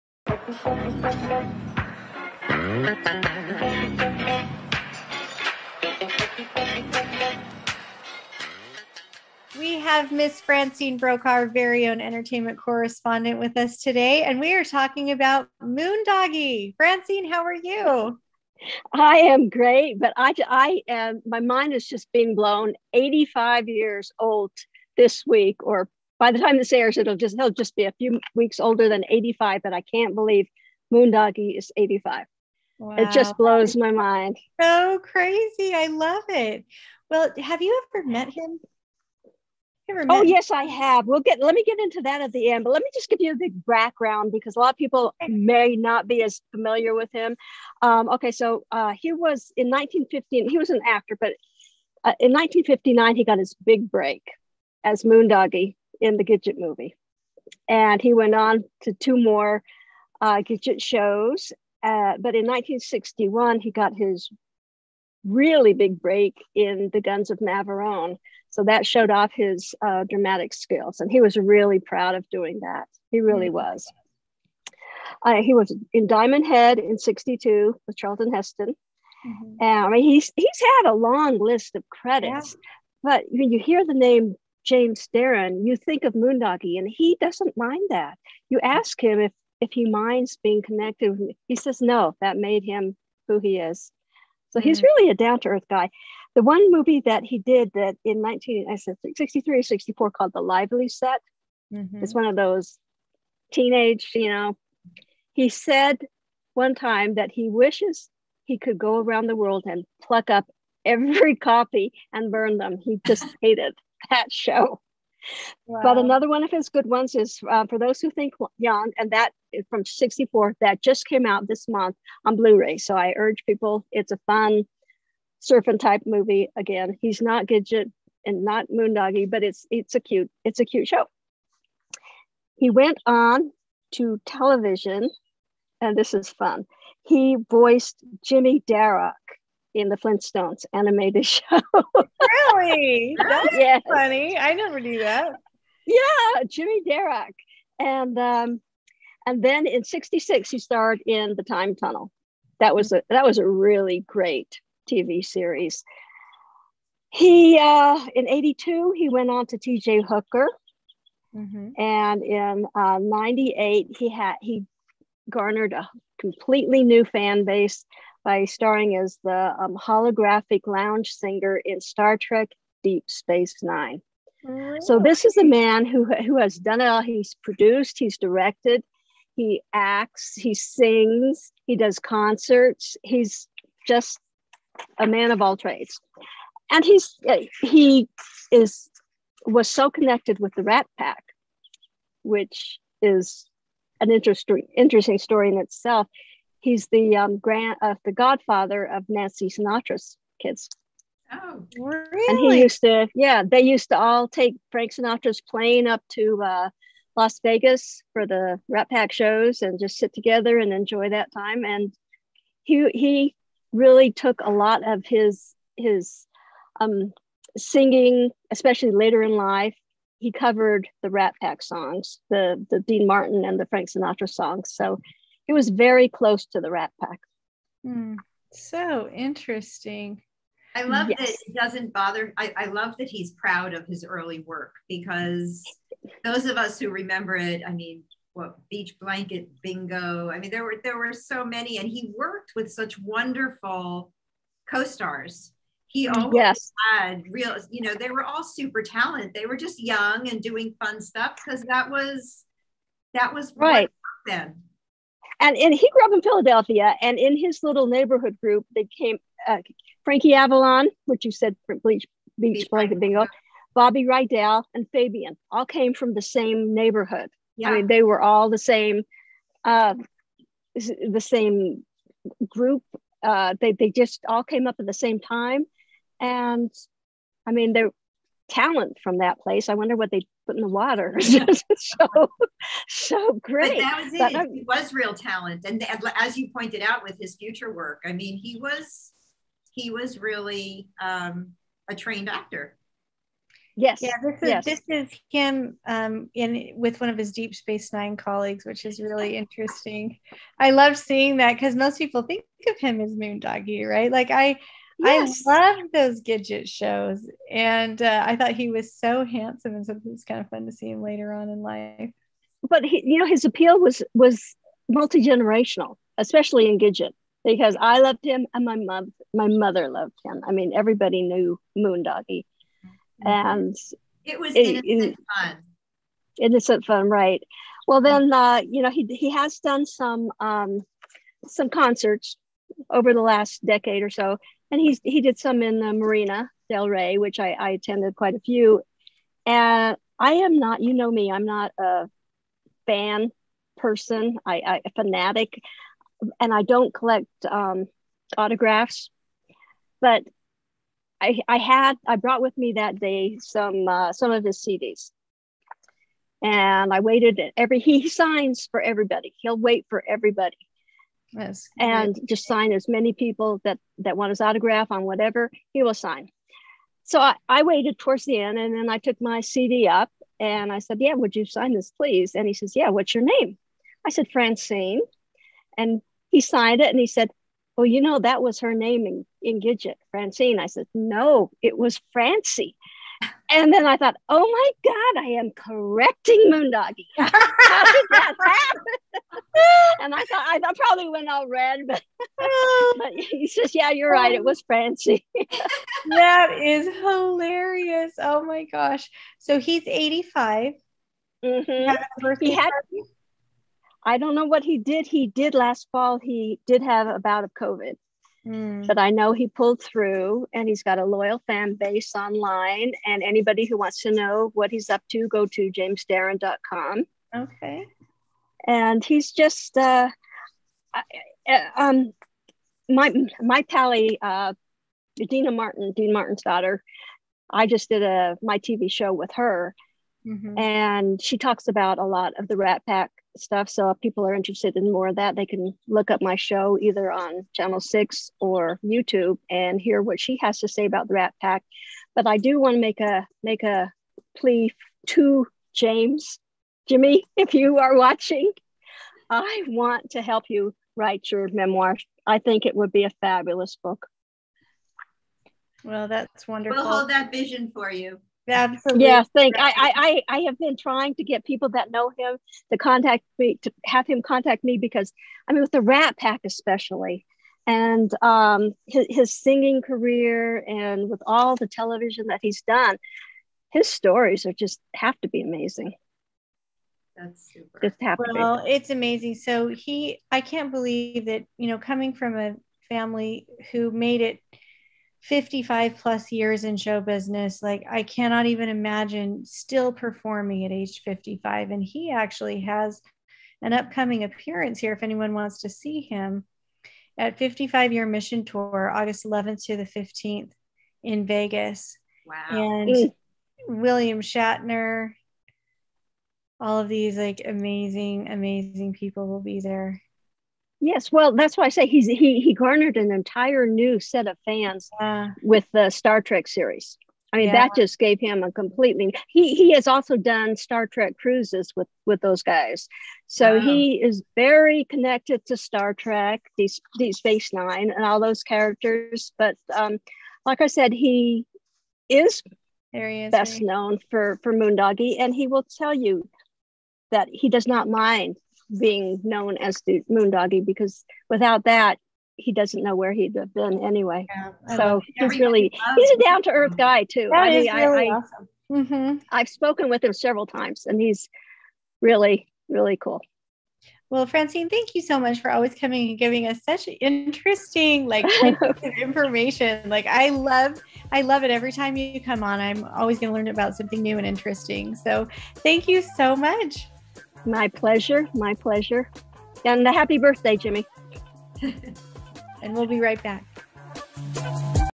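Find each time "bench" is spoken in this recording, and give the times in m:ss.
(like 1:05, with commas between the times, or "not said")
not said.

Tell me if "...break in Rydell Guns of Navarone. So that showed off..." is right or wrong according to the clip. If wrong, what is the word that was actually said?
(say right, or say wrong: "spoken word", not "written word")
wrong: "The", not "Rydell".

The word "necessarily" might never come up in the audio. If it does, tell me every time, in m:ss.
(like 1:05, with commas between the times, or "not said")
not said.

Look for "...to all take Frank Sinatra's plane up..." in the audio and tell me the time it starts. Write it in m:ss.
3:23.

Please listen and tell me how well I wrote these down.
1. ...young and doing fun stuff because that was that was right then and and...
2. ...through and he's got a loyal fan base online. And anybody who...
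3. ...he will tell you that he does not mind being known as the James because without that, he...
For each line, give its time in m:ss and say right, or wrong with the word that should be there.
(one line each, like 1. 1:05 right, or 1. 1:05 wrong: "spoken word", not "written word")
1. 4:09 right
2. 6:49 right
3. 8:55 wrong: "Moondoggy", not "James".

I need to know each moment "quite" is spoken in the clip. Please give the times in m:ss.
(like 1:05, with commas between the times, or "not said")
5:38.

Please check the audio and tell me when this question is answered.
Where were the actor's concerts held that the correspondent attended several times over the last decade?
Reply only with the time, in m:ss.
5:35.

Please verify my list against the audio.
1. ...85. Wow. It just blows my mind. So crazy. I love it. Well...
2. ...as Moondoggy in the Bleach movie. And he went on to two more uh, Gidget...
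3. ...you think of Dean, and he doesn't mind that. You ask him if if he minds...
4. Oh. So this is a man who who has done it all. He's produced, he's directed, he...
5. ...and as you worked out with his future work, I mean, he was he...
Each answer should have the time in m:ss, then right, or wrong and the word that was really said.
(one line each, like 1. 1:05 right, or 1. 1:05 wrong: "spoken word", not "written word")
1. 0:31 right
2. 0:54 wrong: "Gidget", not "Bleach"
3. 1:25 wrong: "Moondoggy", not "Dean"
4. 2:54 right
5. 4:45 wrong: "pointed", not "worked".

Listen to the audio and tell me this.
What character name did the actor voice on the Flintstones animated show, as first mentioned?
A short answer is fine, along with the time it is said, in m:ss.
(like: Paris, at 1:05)
Jimmy Darrock, at 2:18.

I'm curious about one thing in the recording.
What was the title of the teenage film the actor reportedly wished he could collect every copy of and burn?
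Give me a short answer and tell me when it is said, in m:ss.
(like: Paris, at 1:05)
The Lively Set, at 1:40.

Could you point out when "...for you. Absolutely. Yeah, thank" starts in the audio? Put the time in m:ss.
7:37.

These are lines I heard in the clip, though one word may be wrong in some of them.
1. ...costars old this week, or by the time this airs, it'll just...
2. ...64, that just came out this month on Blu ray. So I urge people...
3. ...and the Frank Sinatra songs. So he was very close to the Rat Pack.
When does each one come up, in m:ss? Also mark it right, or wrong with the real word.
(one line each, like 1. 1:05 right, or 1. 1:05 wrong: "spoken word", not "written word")
1. 0:23 wrong: "years", not "costars"
2. 1:59 right
3. 3:43 right.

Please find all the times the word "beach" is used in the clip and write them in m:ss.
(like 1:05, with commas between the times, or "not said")
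3:58, 4:22.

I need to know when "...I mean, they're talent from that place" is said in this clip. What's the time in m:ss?
4:37.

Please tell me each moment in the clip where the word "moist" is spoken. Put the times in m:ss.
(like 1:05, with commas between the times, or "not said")
not said.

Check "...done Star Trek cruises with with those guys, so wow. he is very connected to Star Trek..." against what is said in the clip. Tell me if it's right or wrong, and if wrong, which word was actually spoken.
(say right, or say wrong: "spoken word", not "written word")
right.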